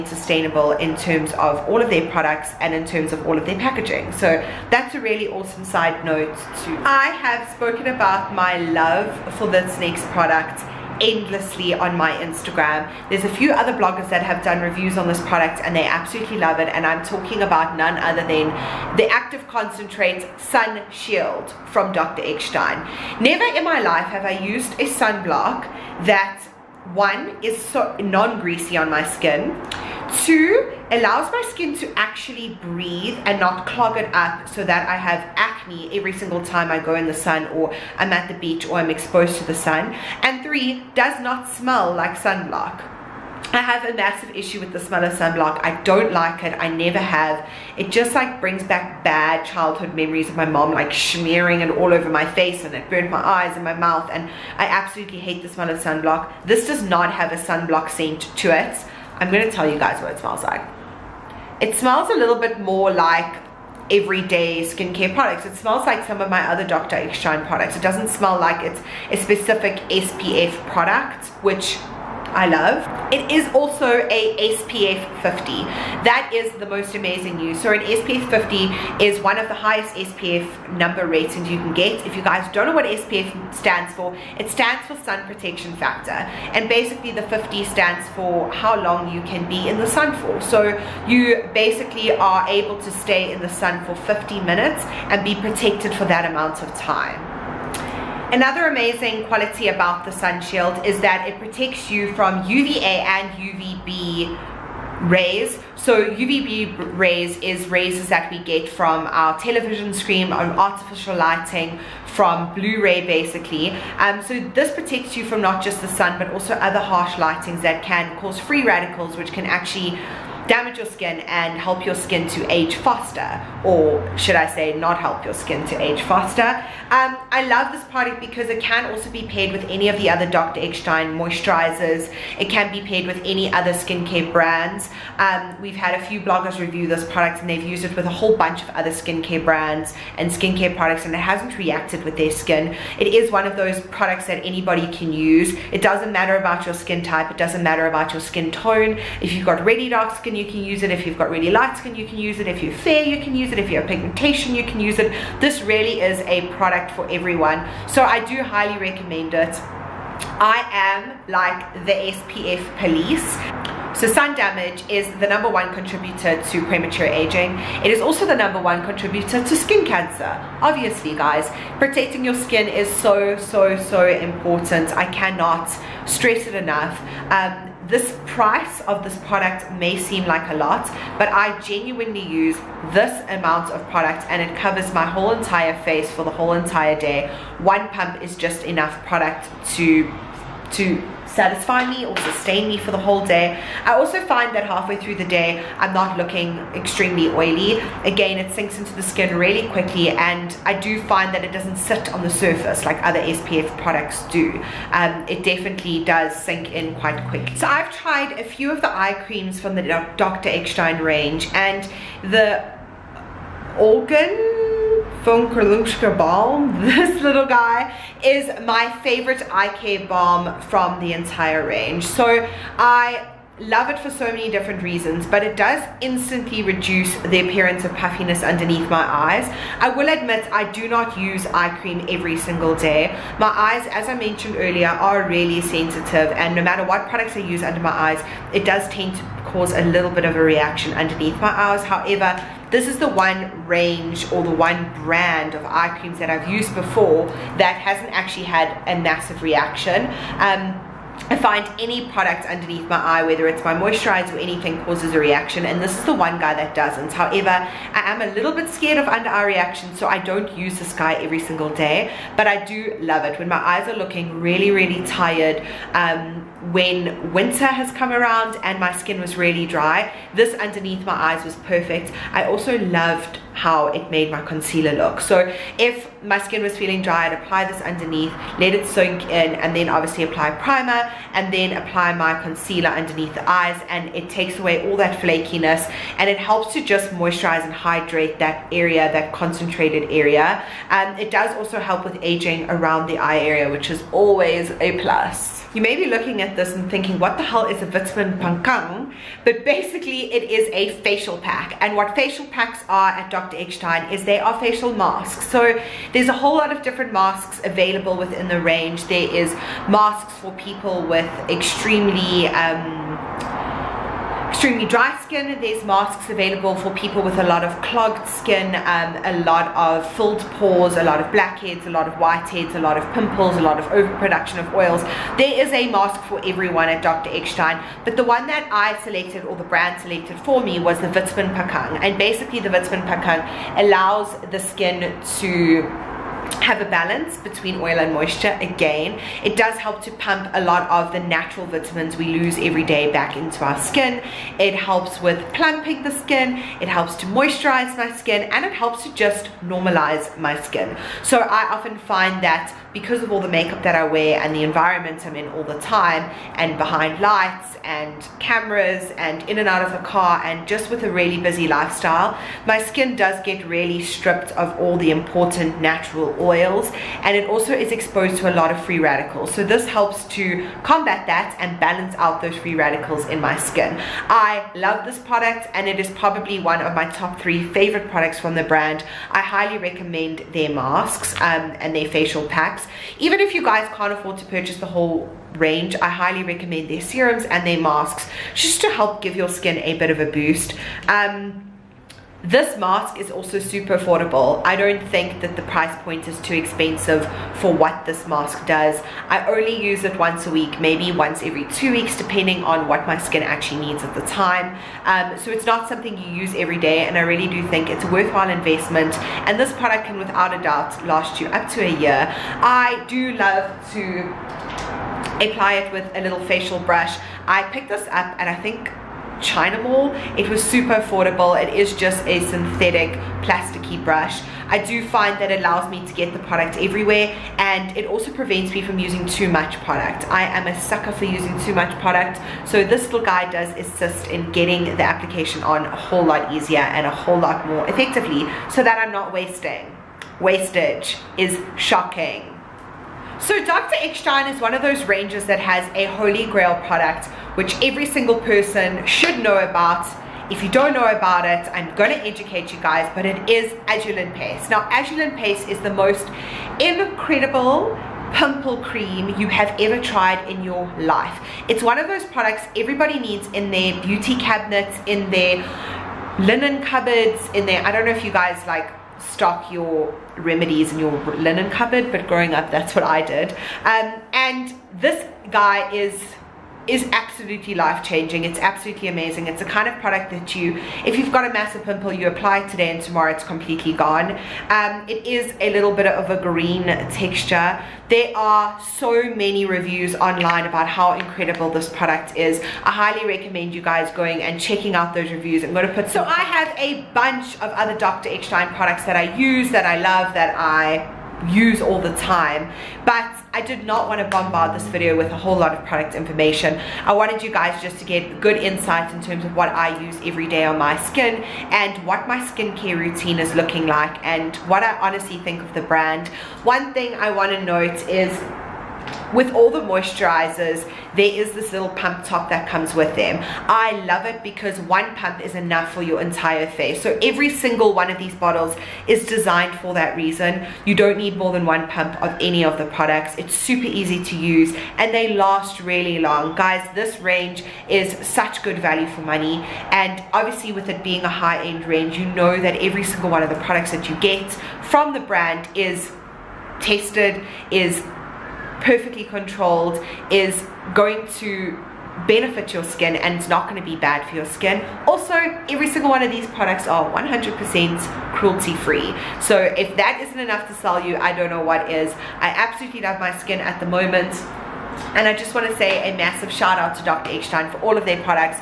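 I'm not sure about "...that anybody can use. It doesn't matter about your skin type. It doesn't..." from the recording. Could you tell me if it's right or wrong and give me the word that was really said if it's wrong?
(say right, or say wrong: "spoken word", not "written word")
right.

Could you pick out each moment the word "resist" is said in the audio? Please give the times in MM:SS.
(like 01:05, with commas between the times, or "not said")
not said.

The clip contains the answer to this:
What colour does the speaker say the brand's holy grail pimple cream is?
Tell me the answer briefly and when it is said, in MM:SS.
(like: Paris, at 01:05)
green, at 08:06.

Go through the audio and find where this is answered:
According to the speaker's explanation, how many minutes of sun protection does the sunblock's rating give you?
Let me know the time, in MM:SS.
01:33.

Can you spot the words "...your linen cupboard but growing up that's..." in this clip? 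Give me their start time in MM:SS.
07:50.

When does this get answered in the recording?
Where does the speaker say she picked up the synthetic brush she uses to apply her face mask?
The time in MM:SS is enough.
06:59.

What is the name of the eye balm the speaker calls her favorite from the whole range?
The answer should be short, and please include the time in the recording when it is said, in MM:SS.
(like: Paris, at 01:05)
Olgan Von Kerlushka Balm, at 03:33.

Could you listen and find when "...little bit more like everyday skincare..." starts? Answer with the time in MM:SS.
01:02.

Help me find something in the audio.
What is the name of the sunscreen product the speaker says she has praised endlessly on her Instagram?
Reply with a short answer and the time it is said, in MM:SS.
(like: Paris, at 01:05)
Active Concentrates Sun Shield, at 00:19.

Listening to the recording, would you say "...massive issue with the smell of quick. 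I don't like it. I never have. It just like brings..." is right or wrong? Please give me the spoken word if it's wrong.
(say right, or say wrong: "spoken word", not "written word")
wrong: "sunblock", not "quick".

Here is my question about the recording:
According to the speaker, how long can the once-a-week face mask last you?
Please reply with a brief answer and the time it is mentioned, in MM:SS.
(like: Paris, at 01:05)
up to a year, at 06:51.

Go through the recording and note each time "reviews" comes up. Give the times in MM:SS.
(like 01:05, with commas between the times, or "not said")
00:14, 02:16, 08:09, 08:15.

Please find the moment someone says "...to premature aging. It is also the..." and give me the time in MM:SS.
02:46.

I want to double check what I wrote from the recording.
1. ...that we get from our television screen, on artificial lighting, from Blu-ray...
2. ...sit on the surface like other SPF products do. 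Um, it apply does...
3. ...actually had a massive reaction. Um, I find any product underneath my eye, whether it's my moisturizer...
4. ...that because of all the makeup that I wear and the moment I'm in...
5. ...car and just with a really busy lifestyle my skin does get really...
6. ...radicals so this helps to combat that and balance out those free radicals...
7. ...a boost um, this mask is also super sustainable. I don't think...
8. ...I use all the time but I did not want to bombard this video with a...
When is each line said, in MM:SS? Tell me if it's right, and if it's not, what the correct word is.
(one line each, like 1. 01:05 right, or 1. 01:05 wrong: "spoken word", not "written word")
1. 01:48 right
2. 03:21 wrong: "definitely", not "apply"
3. 04:08 right
4. 05:52 wrong: "environment", not "moment"
5. 06:00 right
6. 06:08 right
7. 06:30 wrong: "affordable", not "sustainable"
8. 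08:20 right.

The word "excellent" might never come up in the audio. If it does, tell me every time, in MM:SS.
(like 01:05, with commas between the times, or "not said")
not said.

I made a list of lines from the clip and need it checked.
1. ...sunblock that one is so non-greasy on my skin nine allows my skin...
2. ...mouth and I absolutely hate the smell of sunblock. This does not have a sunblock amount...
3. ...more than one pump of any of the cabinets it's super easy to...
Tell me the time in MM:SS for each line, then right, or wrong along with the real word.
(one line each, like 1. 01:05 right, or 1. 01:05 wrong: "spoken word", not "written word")
1. 00:24 wrong: "two", not "nine"
2. 00:53 wrong: "scent", not "amount"
3. 08:51 wrong: "products", not "cabinets".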